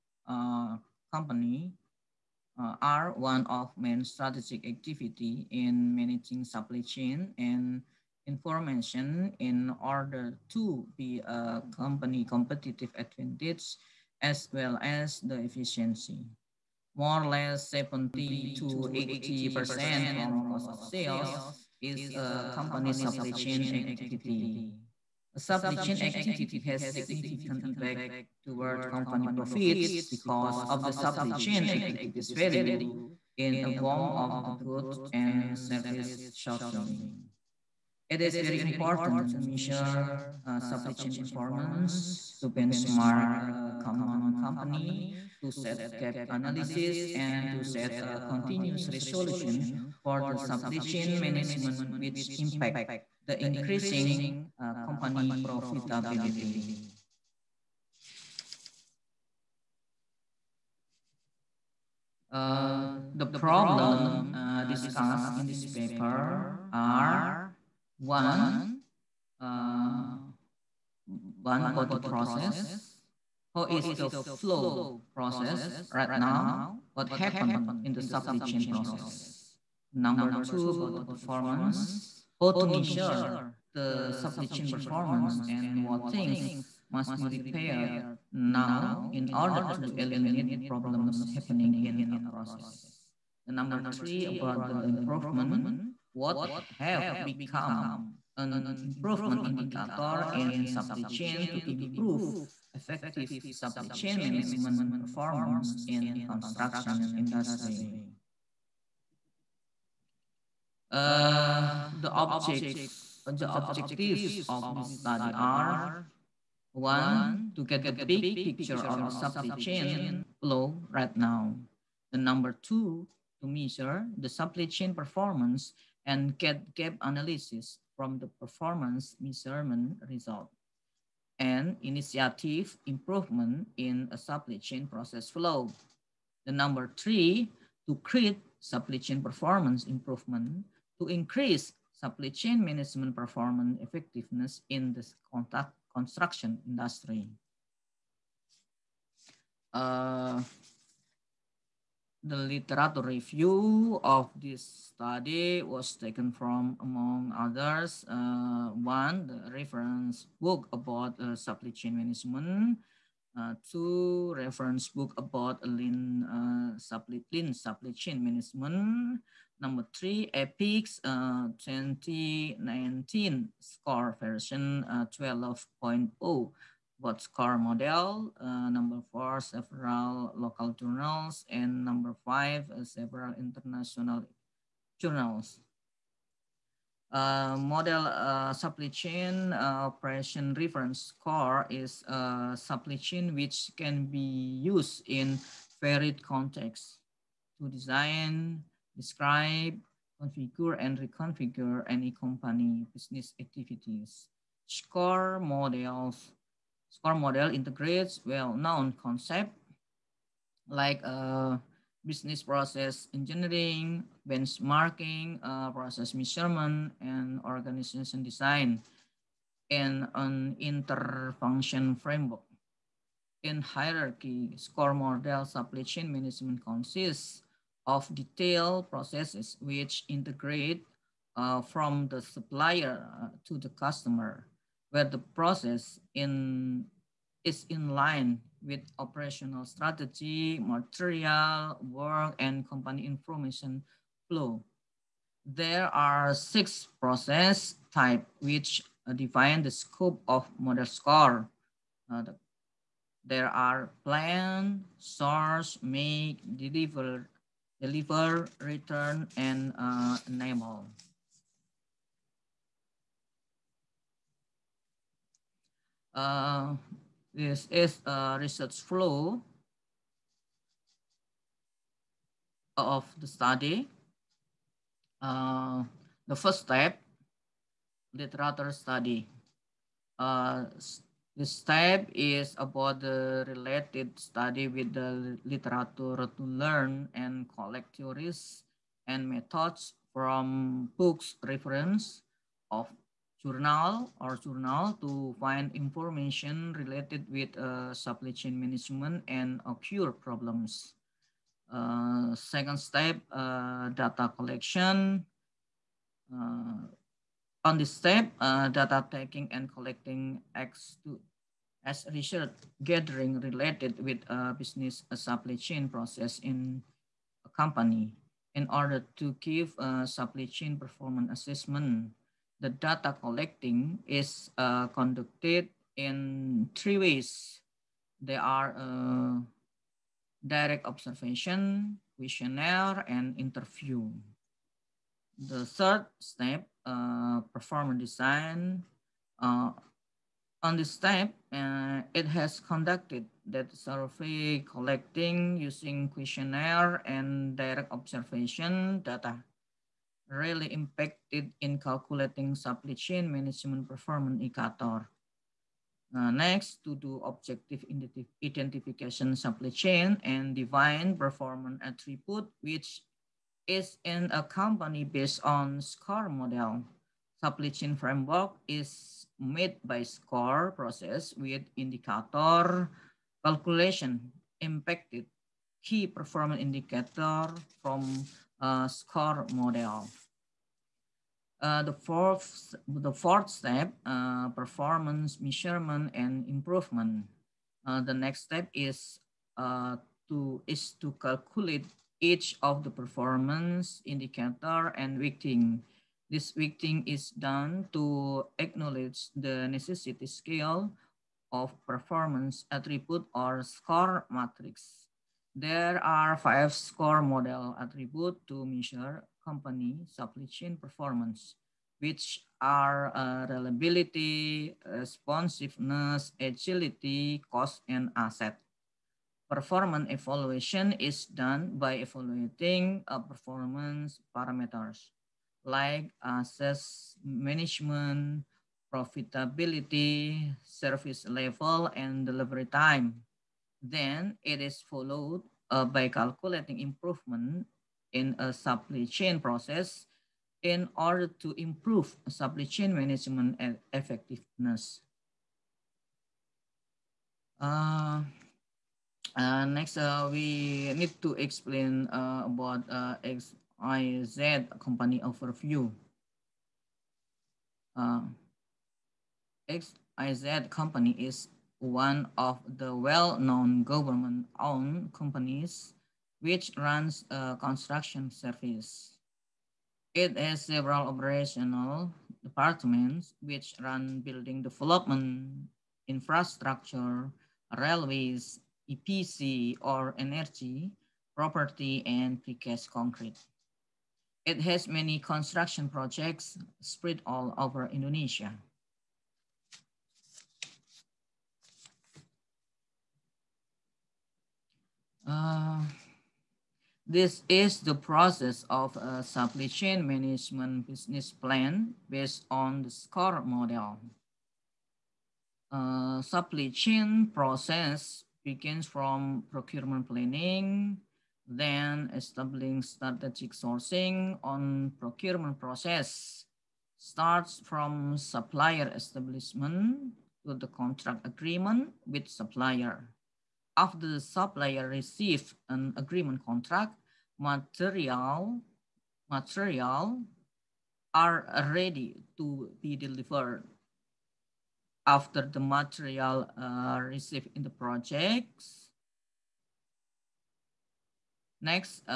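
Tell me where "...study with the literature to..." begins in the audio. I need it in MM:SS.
04:44.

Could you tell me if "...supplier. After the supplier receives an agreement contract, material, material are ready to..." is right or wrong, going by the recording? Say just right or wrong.
right.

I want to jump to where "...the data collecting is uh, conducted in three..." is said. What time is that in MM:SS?
05:22.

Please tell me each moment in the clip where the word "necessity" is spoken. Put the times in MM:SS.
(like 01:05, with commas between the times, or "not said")
06:39.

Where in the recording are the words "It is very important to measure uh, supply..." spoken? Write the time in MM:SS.
00:38.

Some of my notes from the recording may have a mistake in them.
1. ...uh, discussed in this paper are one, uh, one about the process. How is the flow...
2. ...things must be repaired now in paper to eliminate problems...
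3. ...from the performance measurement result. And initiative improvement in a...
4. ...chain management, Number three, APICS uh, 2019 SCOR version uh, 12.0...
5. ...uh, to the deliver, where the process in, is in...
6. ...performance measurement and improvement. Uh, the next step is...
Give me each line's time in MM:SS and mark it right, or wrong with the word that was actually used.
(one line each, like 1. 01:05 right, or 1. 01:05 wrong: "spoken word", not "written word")
1. 01:04 right
2. 01:26 wrong: "order", not "paper"
3. 02:07 right
4. 02:47 right
5. 03:53 wrong: "customer", not "deliver"
6. 06:24 right.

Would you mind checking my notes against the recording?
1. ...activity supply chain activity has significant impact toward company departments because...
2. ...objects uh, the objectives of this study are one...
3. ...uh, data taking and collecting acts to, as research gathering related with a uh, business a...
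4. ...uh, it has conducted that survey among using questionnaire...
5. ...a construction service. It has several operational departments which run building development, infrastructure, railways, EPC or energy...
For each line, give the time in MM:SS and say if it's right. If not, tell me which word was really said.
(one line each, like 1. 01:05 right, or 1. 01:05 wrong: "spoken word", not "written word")
1. 00:23 wrong: "profits", not "departments"
2. 01:52 right
3. 05:08 right
4. 05:41 wrong: "collecting", not "among"
5. 07:47 right.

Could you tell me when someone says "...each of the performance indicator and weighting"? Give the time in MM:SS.
06:32.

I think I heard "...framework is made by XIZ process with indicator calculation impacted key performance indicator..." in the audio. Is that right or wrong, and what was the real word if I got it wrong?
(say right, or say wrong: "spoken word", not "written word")
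wrong: "SCOR", not "XIZ".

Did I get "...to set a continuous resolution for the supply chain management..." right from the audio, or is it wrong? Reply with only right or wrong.
right.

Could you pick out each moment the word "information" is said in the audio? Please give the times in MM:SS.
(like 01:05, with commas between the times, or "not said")
00:08, 04:03, 04:55.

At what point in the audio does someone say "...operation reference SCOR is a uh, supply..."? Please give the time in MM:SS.
03:09.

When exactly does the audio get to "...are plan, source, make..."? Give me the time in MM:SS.
04:13.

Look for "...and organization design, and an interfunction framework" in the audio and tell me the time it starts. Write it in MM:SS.
03:37.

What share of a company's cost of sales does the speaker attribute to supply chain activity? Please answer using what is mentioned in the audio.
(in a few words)
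70 to 80%.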